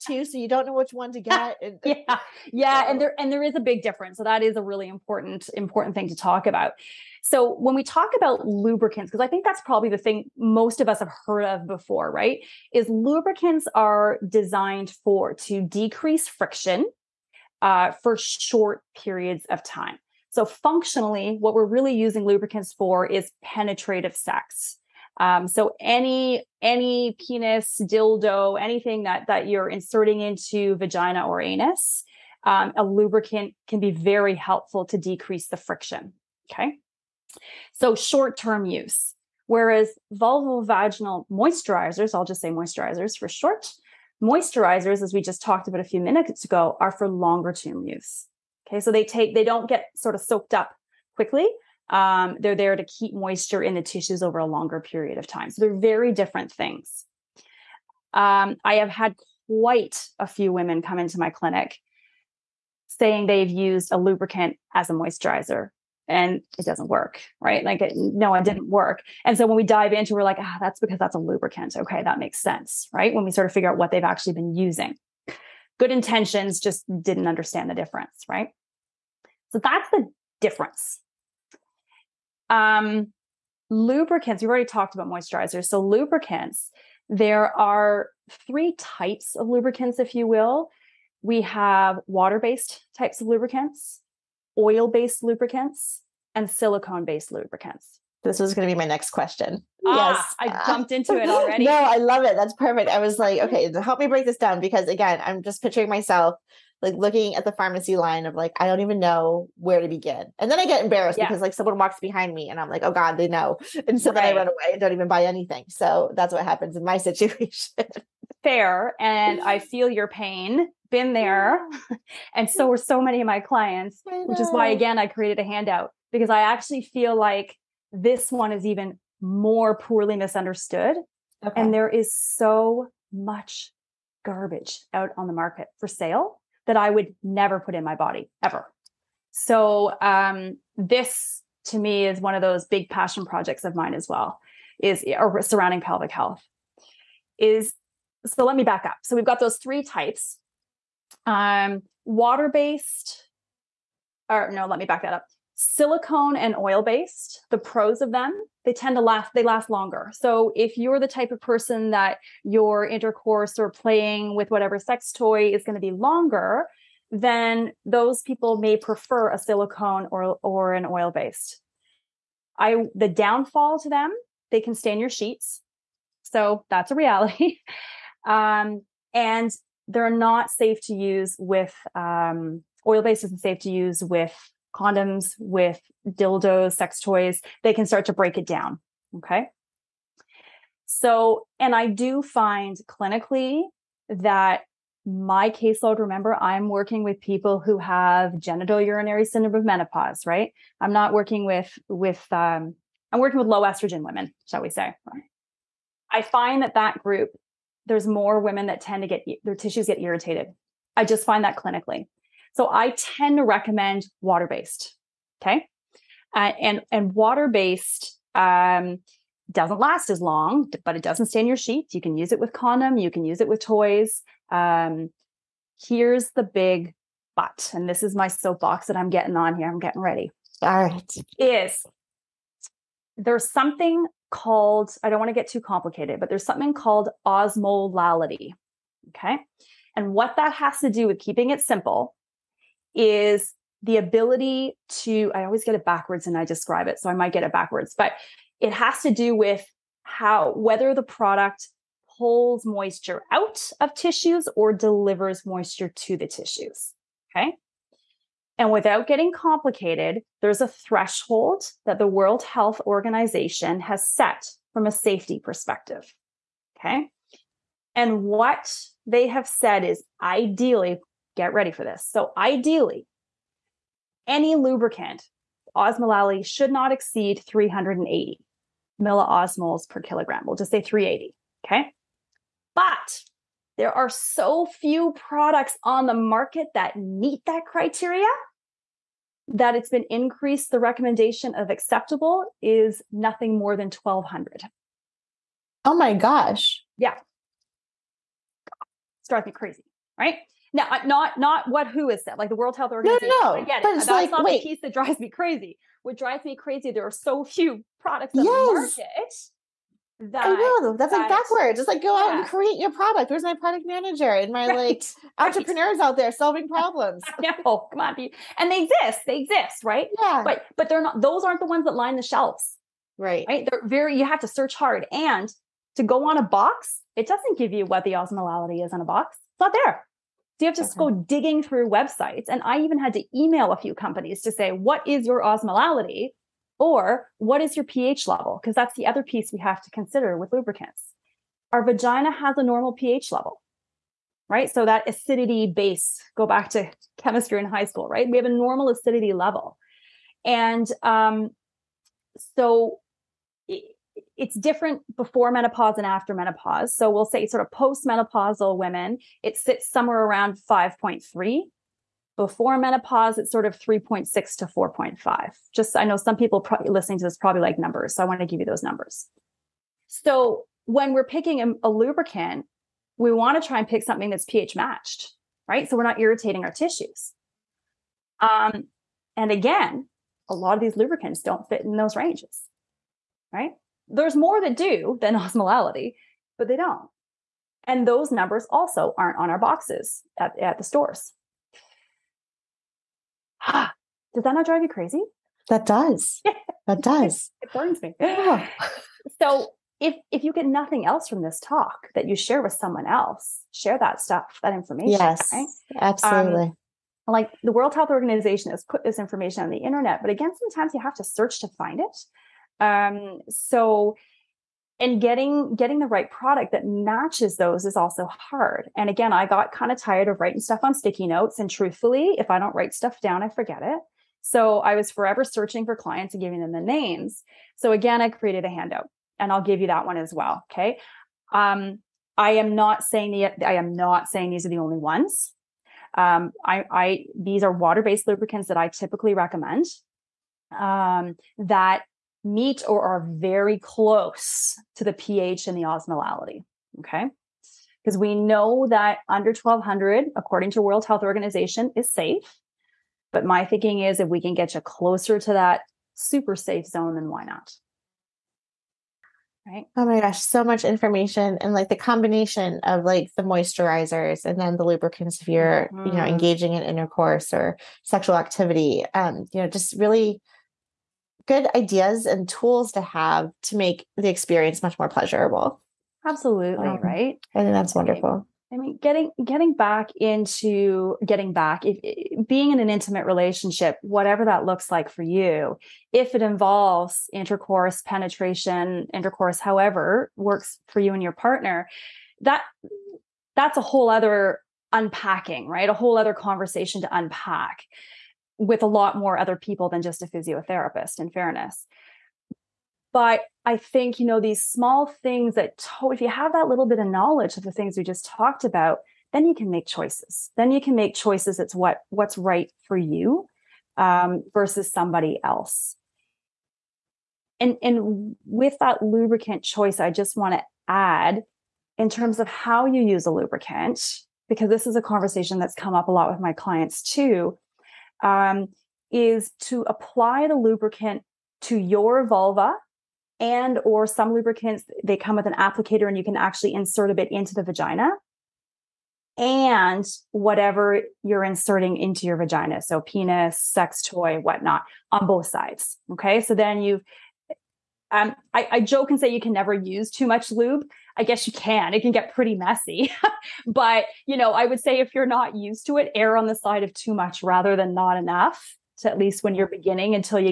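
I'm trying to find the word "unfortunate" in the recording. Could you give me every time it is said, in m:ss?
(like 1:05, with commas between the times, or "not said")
not said.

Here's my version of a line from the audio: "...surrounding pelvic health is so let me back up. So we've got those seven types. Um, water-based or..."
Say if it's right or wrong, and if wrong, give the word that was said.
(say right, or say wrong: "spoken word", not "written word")
wrong: "three", not "seven".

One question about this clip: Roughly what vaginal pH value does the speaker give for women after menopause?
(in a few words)
5.3.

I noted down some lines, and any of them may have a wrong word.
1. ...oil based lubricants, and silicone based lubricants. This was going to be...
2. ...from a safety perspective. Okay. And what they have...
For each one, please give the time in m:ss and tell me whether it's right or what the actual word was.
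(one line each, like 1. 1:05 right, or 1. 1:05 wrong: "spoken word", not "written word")
1. 1:34 right
2. 4:24 right.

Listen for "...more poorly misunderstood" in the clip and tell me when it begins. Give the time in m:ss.
2:09.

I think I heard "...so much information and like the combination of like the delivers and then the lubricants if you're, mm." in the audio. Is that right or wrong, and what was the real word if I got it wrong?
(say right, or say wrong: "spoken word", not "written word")
wrong: "moisturizers", not "delivers".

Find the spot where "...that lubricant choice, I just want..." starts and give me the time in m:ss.
8:38.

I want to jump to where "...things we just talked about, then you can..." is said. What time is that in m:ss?
8:27.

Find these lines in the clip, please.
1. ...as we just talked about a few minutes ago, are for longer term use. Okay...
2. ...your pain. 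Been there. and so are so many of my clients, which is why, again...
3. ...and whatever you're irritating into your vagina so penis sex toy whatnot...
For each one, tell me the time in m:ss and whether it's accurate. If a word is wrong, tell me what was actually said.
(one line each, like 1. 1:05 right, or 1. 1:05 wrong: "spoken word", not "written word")
1. 0:45 right
2. 1:59 right
3. 8:59 wrong: "inserting", not "irritating".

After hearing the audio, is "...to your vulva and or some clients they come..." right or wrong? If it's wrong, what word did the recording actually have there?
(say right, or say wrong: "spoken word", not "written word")
wrong: "lubricants", not "clients".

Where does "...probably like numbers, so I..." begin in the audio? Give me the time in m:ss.
6:07.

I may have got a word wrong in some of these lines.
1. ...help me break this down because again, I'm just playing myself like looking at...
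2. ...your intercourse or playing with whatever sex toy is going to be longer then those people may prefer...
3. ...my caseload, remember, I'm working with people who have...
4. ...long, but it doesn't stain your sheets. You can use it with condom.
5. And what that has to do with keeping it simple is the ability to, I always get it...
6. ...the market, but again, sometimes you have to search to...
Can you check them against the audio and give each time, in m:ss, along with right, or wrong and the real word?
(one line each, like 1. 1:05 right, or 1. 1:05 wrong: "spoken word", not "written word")
1. 1:43 wrong: "picturing", not "playing"
2. 2:42 right
3. 3:15 right
4. 3:40 right
5. 3:59 right
6. 6:49 wrong: "internet", not "market".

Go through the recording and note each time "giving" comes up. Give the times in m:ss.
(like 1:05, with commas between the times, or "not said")
7:06.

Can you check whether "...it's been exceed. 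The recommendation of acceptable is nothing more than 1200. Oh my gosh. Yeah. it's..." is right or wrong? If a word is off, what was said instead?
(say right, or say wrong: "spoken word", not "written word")
wrong: "increased", not "exceed".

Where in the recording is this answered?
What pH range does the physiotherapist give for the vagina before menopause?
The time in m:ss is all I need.
6:03.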